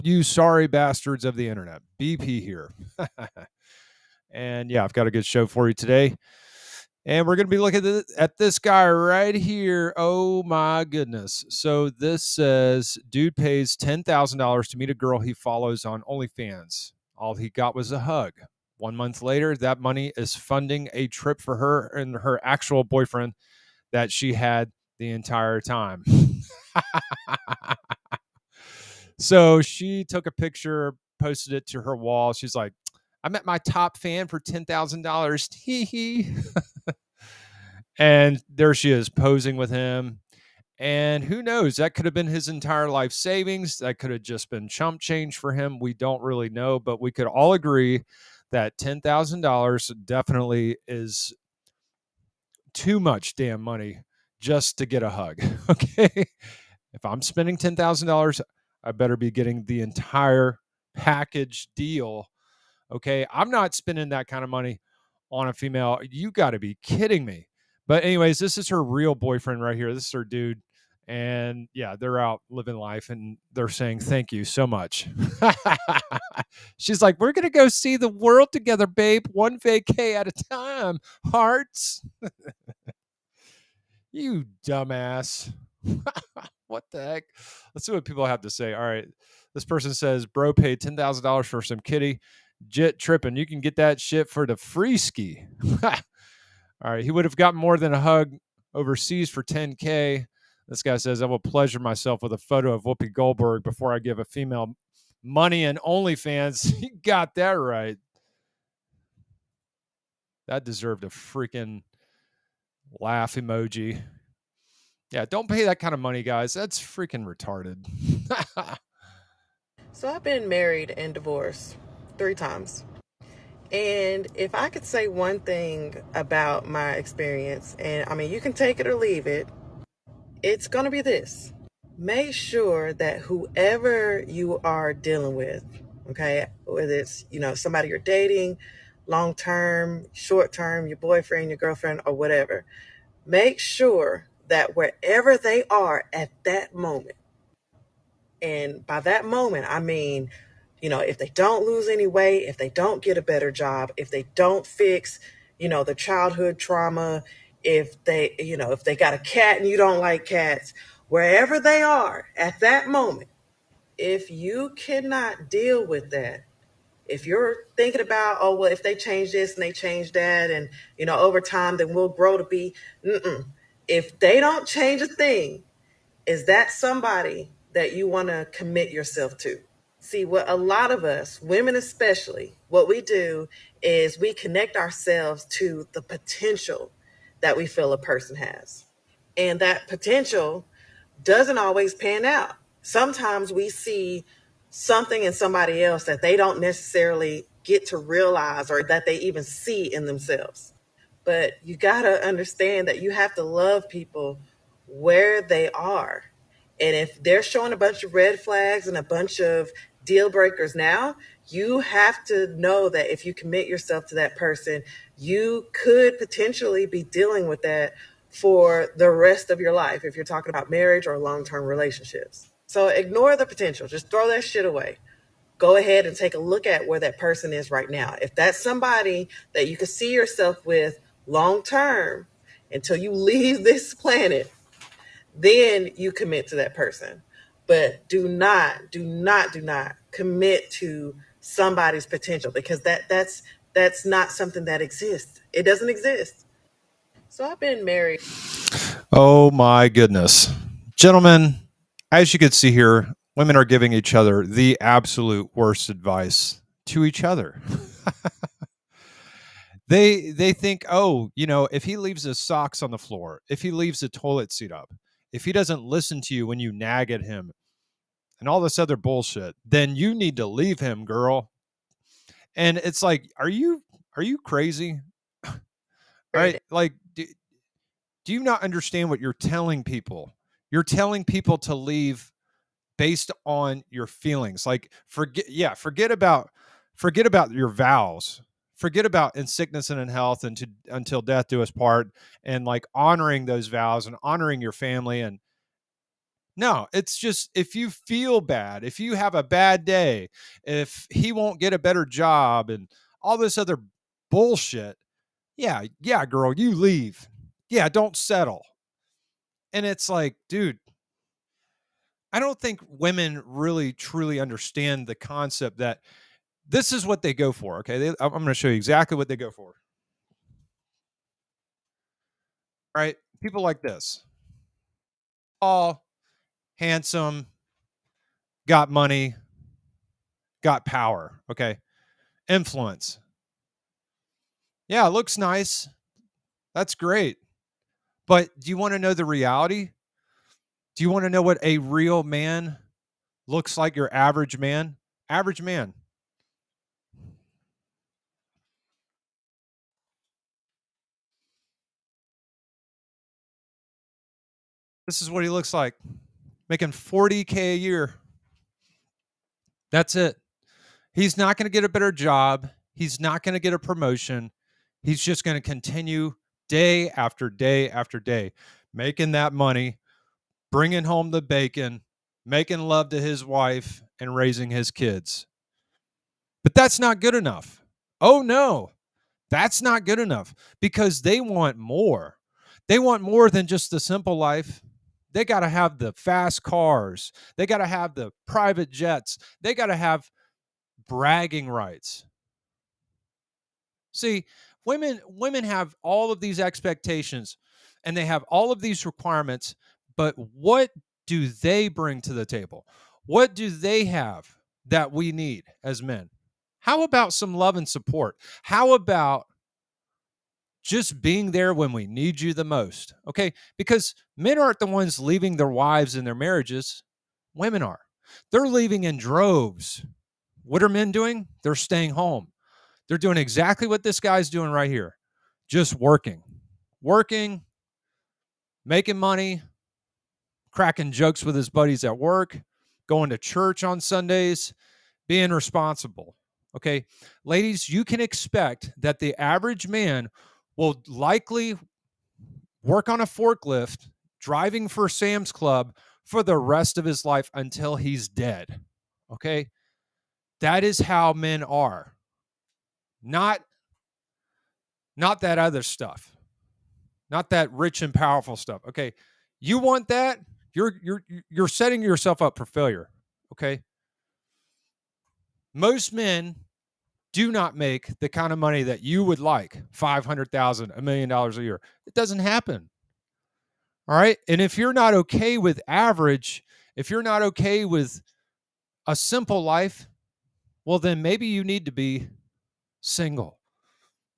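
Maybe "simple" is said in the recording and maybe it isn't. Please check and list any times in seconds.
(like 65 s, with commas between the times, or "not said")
384 s, 479 s.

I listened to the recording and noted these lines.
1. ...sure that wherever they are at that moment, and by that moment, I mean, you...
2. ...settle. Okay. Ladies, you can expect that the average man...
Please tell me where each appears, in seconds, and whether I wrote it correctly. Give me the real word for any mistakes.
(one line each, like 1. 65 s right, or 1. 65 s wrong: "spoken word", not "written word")
1. 143 s right
2. 435 s wrong: "responsible", not "settle".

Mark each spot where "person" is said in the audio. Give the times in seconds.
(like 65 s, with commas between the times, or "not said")
89 s, 187 s, 214 s, 227 s, 236 s.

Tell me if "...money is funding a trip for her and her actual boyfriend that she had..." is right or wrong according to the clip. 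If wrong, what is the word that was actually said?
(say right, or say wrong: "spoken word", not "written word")
right.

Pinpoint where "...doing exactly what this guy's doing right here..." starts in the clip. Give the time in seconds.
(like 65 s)
423 s.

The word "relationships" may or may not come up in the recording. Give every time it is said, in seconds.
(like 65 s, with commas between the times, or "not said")
221 s.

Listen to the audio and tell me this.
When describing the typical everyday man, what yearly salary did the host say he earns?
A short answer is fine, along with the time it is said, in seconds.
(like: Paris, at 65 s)
$40,000, at 356 s.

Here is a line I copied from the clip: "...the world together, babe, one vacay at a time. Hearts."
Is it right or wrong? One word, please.
right.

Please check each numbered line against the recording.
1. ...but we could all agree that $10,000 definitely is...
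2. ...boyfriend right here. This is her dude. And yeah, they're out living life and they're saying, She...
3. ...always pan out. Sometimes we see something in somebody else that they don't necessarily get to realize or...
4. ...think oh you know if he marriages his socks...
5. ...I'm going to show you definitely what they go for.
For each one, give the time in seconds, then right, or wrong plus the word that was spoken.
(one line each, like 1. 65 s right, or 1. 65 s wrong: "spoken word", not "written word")
1. 46 s right
2. 69 s wrong: "Thank", not "She"
3. 191 s right
4. 260 s wrong: "leaves", not "marriages"
5. 318 s wrong: "exactly", not "definitely".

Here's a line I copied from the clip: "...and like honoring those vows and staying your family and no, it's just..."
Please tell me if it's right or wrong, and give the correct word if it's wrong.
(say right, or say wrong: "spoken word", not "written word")
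wrong: "honoring", not "staying".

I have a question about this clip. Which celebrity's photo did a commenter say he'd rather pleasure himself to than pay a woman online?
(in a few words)
Whoopi Goldberg.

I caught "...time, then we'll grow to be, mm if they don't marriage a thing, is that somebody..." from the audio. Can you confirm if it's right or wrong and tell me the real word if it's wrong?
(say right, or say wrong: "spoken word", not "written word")
wrong: "change", not "marriage".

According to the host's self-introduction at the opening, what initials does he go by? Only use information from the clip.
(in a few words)
BP.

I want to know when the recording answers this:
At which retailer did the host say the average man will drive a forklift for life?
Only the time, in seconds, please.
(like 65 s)
445 s.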